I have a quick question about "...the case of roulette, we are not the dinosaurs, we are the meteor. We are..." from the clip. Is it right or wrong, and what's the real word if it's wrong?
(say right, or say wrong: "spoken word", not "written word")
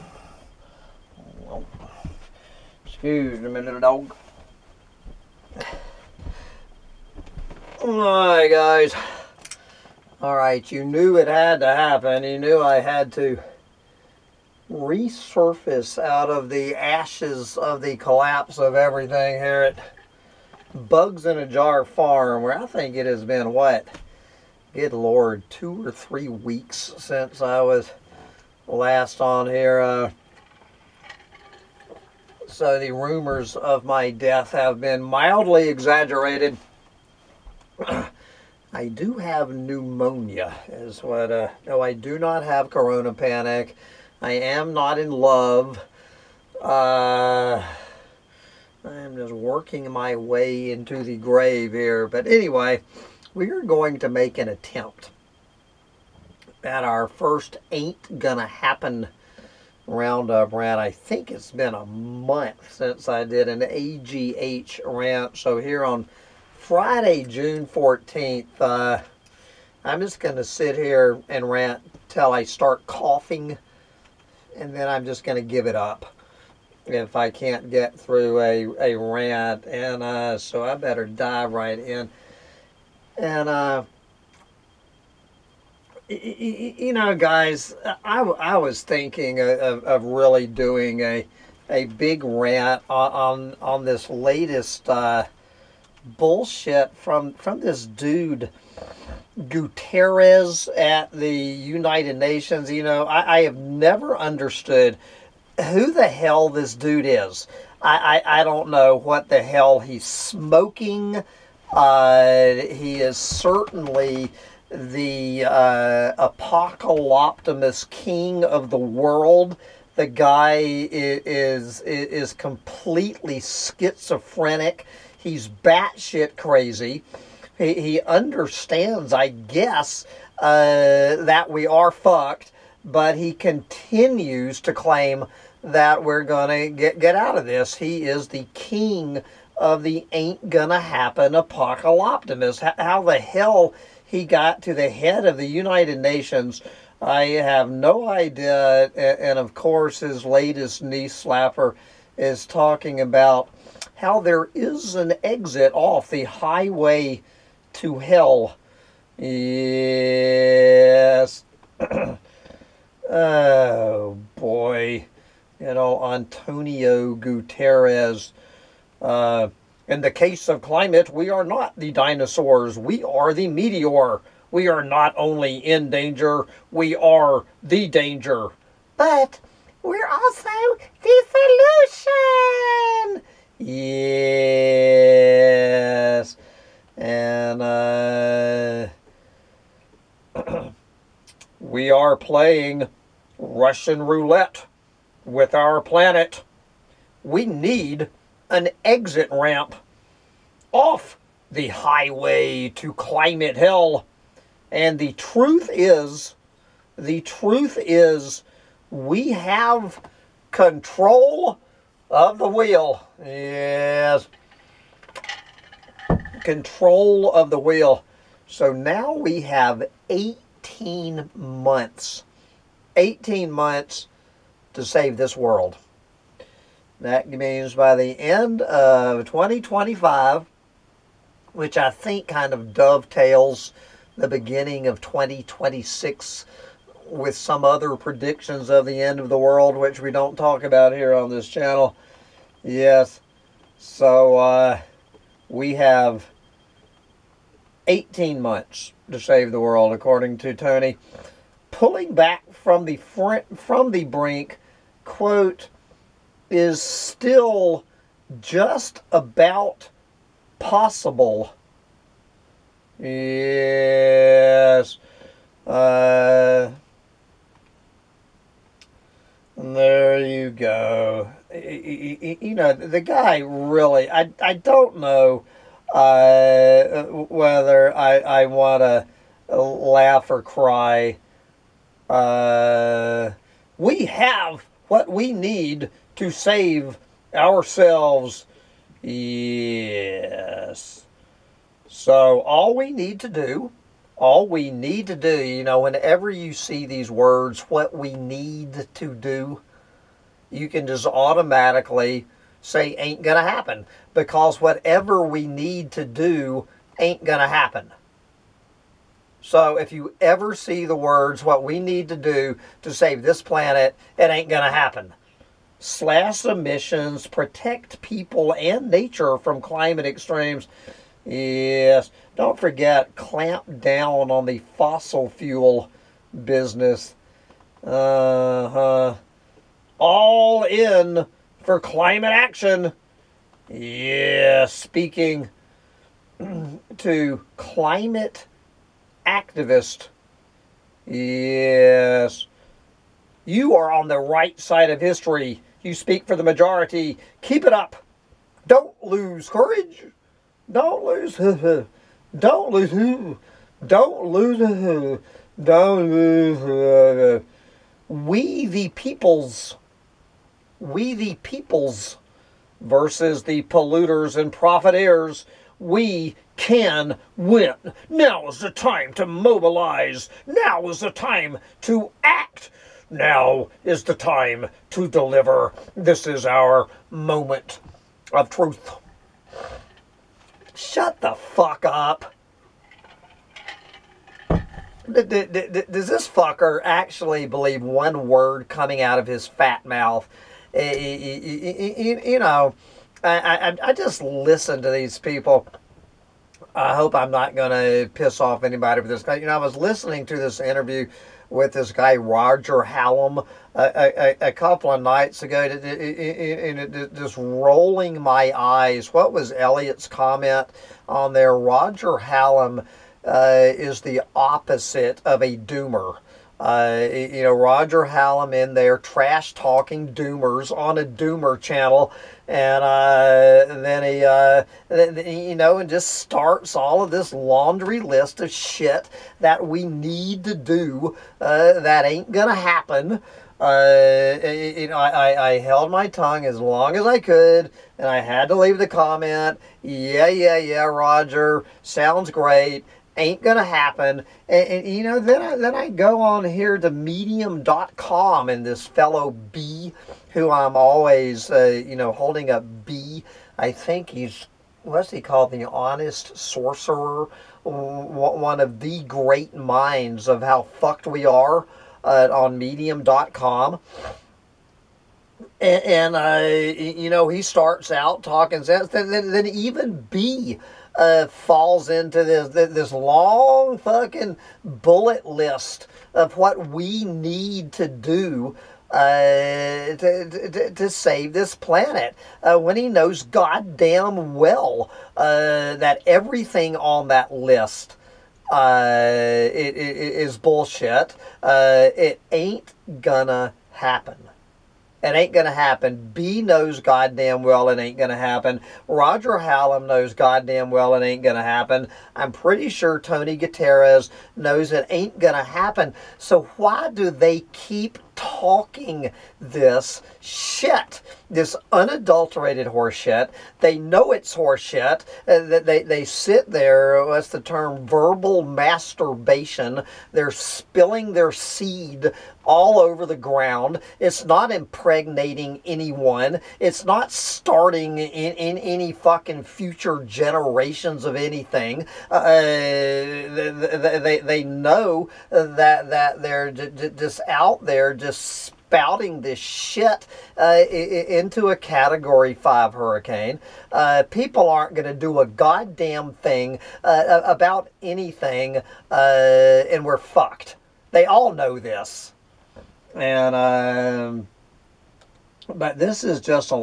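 wrong: "climate", not "roulette".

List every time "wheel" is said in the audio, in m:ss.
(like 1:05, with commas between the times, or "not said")
3:32, 3:37.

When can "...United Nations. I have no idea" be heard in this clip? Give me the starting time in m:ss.
2:25.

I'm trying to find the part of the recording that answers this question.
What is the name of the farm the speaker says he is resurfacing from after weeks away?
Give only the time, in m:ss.
0:20.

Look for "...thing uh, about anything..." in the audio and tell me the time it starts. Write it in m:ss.
9:06.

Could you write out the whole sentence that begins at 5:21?
Yes, don't forget, clamp down on the fossil fuel business.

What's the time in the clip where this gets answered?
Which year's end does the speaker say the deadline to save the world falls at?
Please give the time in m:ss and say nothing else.
3:49.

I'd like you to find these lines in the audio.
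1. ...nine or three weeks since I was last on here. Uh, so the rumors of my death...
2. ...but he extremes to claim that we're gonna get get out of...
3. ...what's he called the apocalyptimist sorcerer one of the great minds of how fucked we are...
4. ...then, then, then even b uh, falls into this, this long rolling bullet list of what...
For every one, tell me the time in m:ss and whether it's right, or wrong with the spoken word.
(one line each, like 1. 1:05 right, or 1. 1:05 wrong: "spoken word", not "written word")
1. 0:25 wrong: "two", not "nine"
2. 2:12 wrong: "continues", not "extremes"
3. 7:34 wrong: "honest", not "apocalyptimist"
4. 7:48 wrong: "fucking", not "rolling".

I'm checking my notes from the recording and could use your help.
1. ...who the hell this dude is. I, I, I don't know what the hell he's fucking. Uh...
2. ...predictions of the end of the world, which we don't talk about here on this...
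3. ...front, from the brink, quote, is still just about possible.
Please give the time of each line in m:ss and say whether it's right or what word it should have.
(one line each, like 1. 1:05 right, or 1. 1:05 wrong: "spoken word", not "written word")
1. 1:45 wrong: "smoking", not "fucking"
2. 3:57 right
3. 4:12 right.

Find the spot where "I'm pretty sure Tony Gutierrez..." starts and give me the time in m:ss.
8:22.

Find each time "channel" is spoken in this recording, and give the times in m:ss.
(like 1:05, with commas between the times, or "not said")
4:01, 7:01.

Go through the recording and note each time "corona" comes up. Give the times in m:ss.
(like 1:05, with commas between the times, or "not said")
0:42.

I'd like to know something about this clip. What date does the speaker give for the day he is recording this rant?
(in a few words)
Friday, June 14th.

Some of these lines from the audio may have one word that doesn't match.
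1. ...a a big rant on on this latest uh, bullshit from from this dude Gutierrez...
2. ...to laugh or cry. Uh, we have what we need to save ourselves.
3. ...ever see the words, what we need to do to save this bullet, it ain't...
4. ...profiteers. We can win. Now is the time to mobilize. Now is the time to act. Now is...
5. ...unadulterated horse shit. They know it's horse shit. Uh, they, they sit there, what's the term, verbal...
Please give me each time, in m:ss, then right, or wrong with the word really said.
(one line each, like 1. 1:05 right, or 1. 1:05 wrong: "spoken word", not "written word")
1. 1:31 right
2. 4:38 right
3. 5:10 wrong: "planet", not "bullet"
4. 6:04 right
5. 8:31 right.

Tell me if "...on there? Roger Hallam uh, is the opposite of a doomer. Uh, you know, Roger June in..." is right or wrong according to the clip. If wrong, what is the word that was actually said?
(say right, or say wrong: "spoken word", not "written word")
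wrong: "Hallam", not "June".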